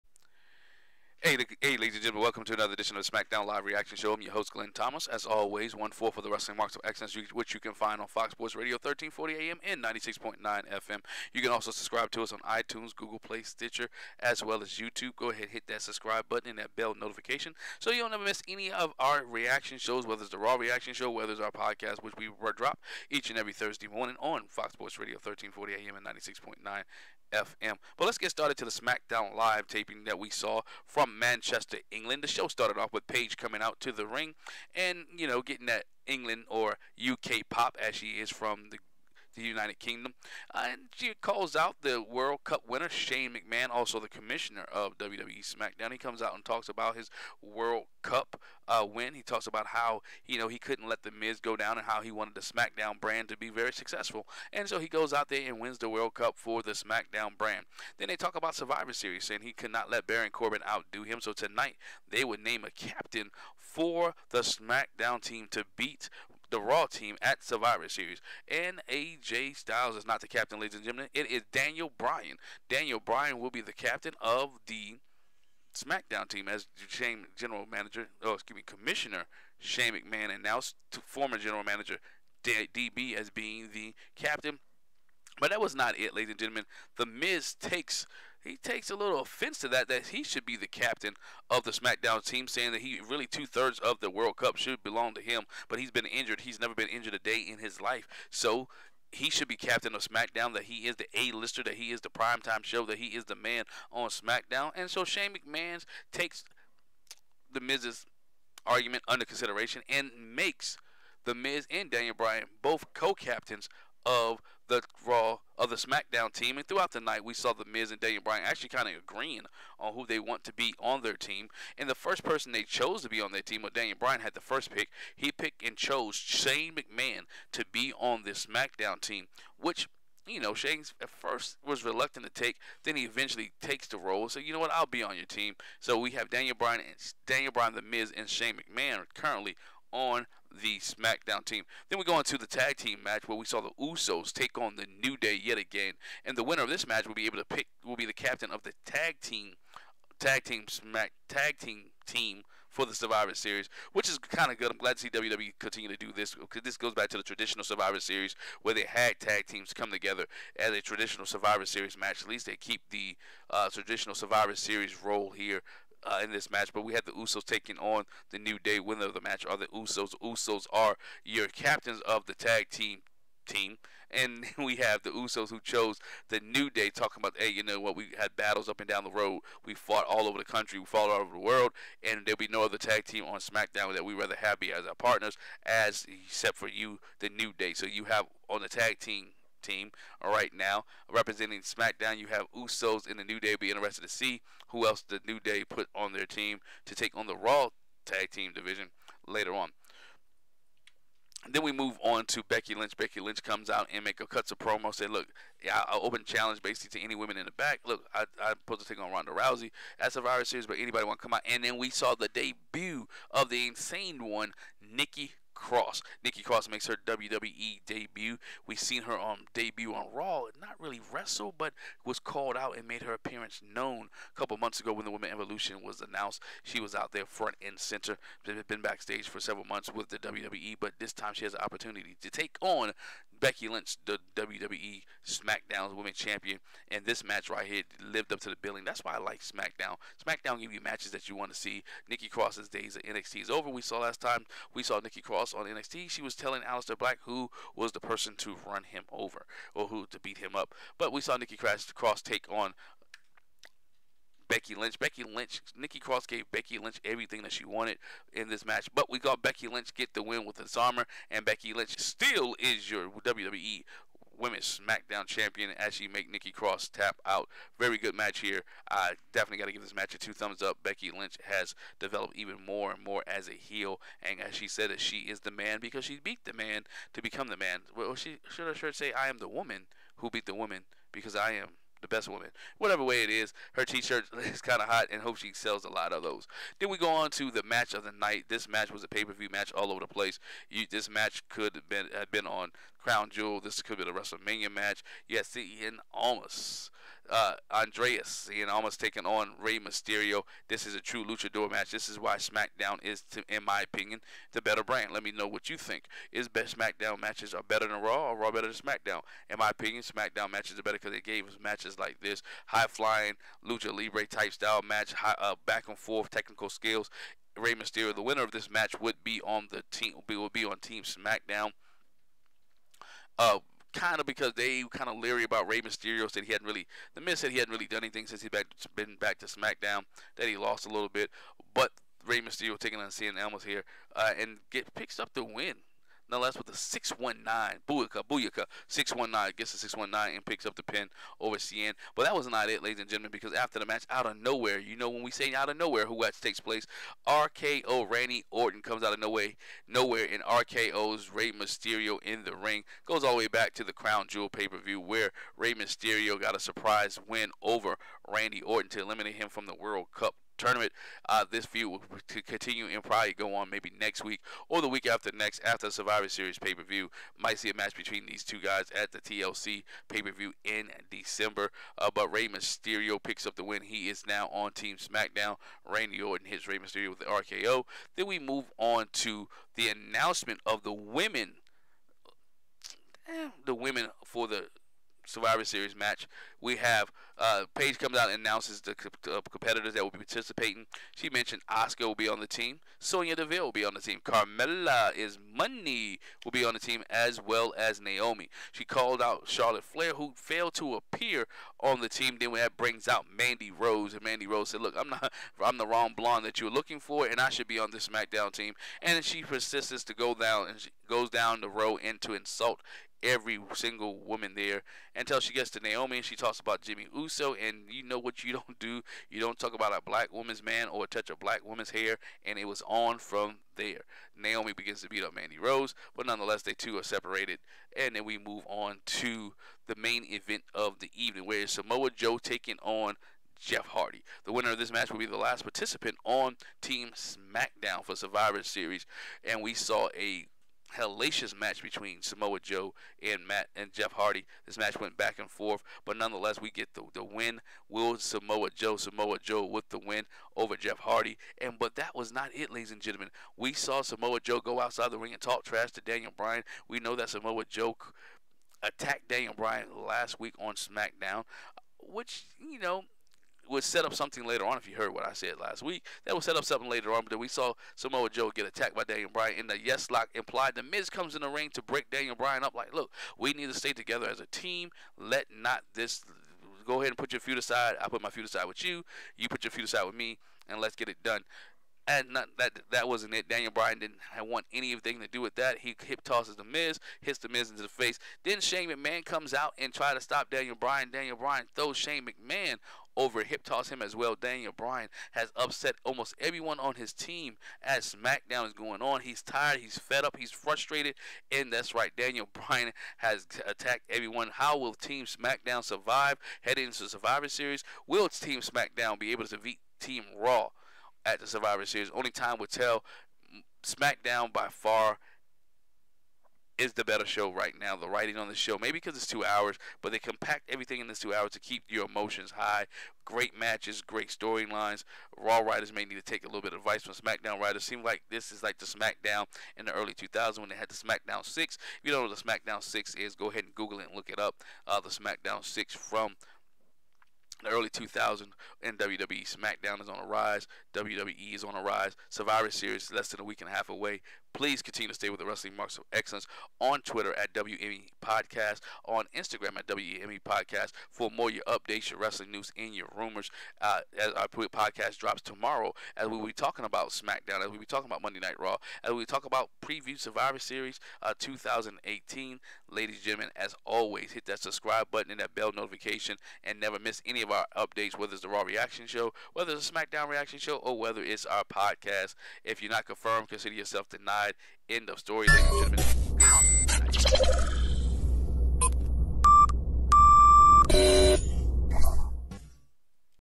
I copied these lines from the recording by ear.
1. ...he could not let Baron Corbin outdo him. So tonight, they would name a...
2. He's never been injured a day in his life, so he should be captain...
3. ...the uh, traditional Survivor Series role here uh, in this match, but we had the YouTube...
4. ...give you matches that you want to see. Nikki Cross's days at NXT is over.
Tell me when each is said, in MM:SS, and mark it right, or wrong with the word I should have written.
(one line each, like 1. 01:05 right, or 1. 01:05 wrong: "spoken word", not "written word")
1. 00:59 right
2. 01:36 right
3. 02:42 wrong: "Usos", not "YouTube"
4. 04:00 right.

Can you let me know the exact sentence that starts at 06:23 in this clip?
Eh, the women for the Survivor Series match.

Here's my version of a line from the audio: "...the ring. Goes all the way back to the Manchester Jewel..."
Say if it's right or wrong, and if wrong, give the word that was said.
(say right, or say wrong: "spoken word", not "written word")
wrong: "Crown", not "Manchester".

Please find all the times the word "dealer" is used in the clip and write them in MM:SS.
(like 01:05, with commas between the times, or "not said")
not said.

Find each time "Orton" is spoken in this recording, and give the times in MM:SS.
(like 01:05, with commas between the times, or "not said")
05:48, 05:58, 06:16.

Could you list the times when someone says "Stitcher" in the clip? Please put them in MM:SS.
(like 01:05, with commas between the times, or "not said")
00:13.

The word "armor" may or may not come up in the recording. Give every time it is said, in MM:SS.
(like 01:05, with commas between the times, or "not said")
04:20.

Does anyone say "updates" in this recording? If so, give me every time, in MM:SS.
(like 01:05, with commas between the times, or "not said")
09:11, 09:27.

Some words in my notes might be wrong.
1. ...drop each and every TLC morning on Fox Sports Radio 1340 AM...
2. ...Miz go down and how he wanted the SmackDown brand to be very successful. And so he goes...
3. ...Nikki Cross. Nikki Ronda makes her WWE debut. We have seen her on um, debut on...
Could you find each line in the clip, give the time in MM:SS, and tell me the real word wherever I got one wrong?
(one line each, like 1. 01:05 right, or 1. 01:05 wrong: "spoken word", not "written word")
1. 00:22 wrong: "Thursday", not "TLC"
2. 00:51 right
3. 03:34 wrong: "Cross", not "Ronda".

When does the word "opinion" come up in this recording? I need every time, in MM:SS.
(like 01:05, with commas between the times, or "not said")
05:03, 05:09.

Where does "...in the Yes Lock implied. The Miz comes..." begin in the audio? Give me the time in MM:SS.
07:49.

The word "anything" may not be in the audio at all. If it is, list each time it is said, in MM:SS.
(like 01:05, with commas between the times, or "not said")
05:28, 08:04.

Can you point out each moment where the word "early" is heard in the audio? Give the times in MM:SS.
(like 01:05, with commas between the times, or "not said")
08:49, 08:57.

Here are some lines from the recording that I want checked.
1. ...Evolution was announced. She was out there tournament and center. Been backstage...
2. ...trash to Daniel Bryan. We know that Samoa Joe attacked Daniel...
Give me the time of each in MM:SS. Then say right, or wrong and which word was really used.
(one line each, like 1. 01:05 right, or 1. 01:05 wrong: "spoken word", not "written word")
1. 03:45 wrong: "front", not "tournament"
2. 07:35 right.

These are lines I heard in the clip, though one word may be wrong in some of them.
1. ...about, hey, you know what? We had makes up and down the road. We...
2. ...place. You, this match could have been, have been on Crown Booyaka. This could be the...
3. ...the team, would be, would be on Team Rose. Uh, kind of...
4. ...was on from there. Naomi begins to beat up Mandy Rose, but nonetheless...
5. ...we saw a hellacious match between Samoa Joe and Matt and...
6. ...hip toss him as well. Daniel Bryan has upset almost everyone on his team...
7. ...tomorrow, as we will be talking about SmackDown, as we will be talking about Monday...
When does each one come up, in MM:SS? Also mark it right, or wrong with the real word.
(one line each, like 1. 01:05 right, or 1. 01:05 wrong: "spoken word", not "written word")
1. 02:57 wrong: "battles", not "makes"
2. 04:50 wrong: "Jewel", not "Booyaka"
3. 05:19 wrong: "SmackDown", not "Rose"
4. 07:02 right
5. 07:19 right
6. 08:13 right
7. 09:15 right.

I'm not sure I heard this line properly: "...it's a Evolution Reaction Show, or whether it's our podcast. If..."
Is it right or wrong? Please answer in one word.
wrong.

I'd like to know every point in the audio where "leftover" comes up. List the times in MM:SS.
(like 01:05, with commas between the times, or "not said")
not said.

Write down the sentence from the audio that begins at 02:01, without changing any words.
And the first person they chose to be on their team, well, Daniel Bryan had the first pick.